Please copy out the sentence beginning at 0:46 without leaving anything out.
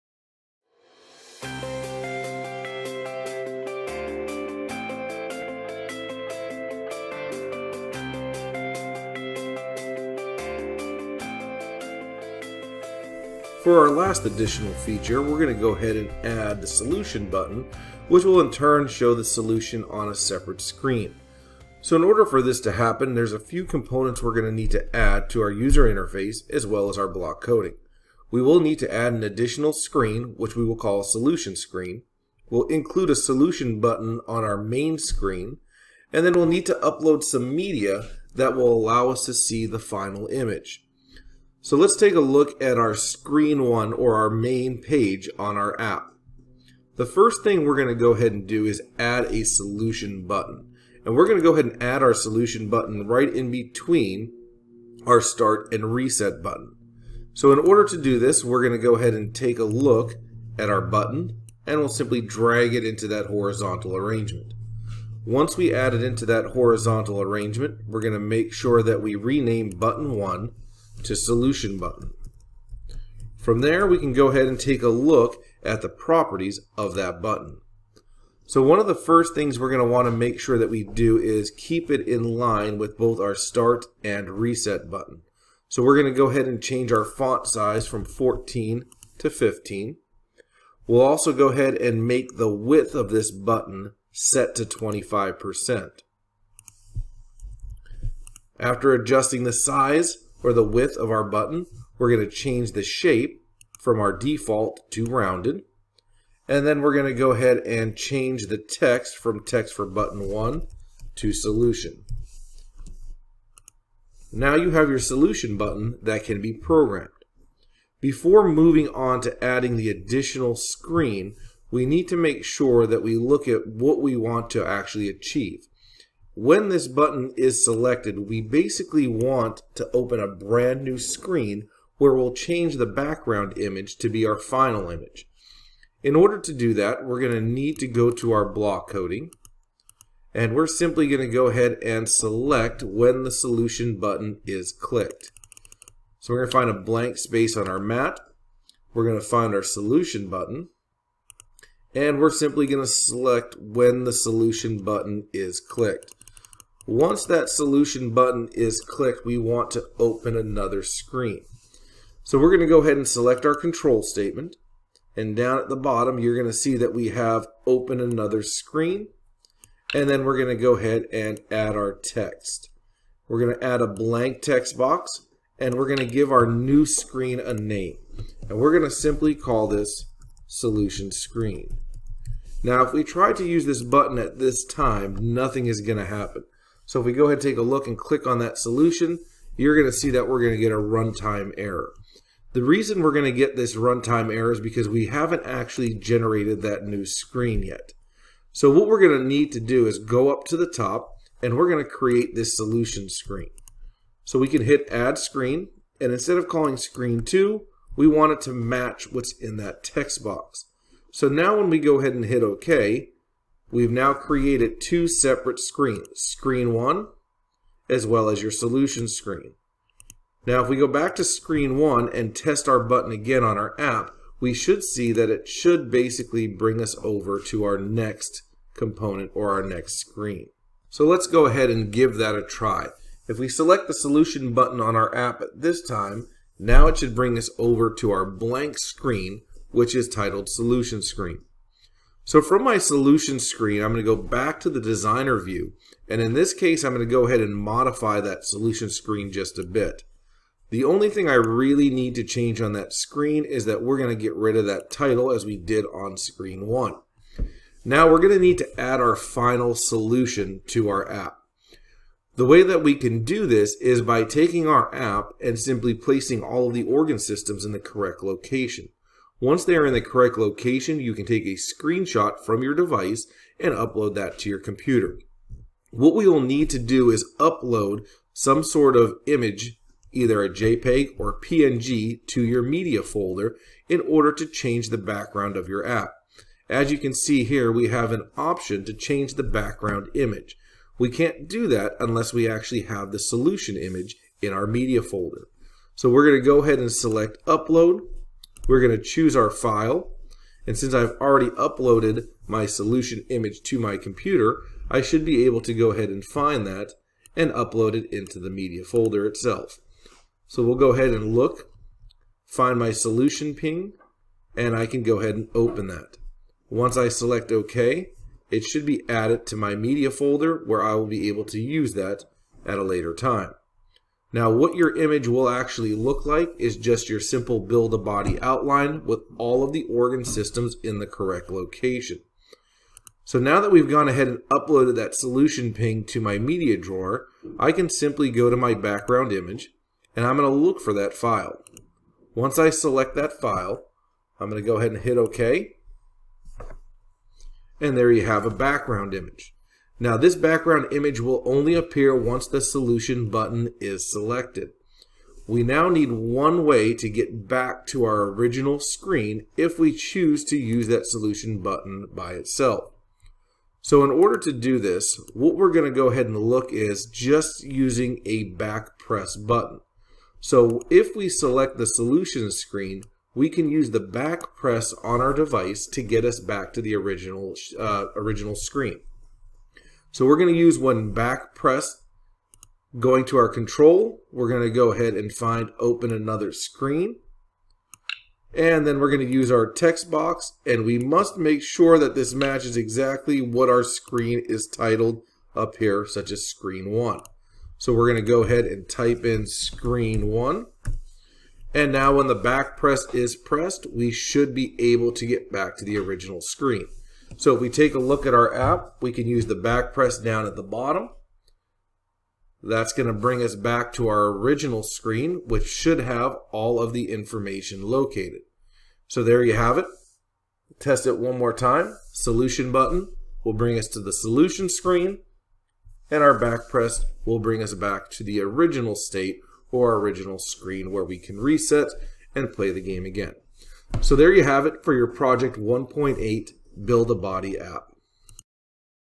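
The first thing we're going to go ahead and do is add a solution button.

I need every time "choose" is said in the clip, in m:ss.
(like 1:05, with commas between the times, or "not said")
4:59, 5:59.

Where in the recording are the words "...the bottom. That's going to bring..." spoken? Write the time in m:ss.
6:50.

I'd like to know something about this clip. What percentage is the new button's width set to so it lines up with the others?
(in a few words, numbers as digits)
25%.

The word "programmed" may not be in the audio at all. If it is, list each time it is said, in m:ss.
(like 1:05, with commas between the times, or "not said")
1:56.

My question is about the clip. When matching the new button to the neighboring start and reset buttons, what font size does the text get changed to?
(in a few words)
15.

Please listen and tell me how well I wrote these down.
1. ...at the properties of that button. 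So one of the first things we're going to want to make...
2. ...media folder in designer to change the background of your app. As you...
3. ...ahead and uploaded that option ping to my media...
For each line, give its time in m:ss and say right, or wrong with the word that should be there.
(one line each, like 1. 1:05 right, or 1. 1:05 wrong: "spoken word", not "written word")
1. 1:15 right
2. 4:42 wrong: "order", not "designer"
3. 5:34 wrong: "solution", not "option".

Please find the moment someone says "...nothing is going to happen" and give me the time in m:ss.
3:05.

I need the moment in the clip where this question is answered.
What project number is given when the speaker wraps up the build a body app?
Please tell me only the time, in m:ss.
7:15.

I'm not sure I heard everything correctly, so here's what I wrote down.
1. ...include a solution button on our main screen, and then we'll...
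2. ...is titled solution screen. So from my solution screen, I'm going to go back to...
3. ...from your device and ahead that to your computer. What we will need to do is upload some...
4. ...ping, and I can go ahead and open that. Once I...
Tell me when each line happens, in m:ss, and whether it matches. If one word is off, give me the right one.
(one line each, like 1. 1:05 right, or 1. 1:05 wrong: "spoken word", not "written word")
1. 0:32 right
2. 3:59 right
3. 4:32 wrong: "upload", not "ahead"
4. 5:13 right.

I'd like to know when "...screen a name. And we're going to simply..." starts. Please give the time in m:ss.
2:56.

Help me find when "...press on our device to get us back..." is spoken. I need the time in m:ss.
6:14.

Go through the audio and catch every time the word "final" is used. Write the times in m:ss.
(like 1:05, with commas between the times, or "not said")
0:39, 2:14, 4:19.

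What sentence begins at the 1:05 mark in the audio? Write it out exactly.
Once we add it into that horizontal arrangement, we're going to make sure that we rename button 1 to solution button.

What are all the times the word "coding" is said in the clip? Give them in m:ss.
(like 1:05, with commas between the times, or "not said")
0:27, 2:18.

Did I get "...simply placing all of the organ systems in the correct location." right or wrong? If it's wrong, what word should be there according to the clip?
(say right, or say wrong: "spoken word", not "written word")
right.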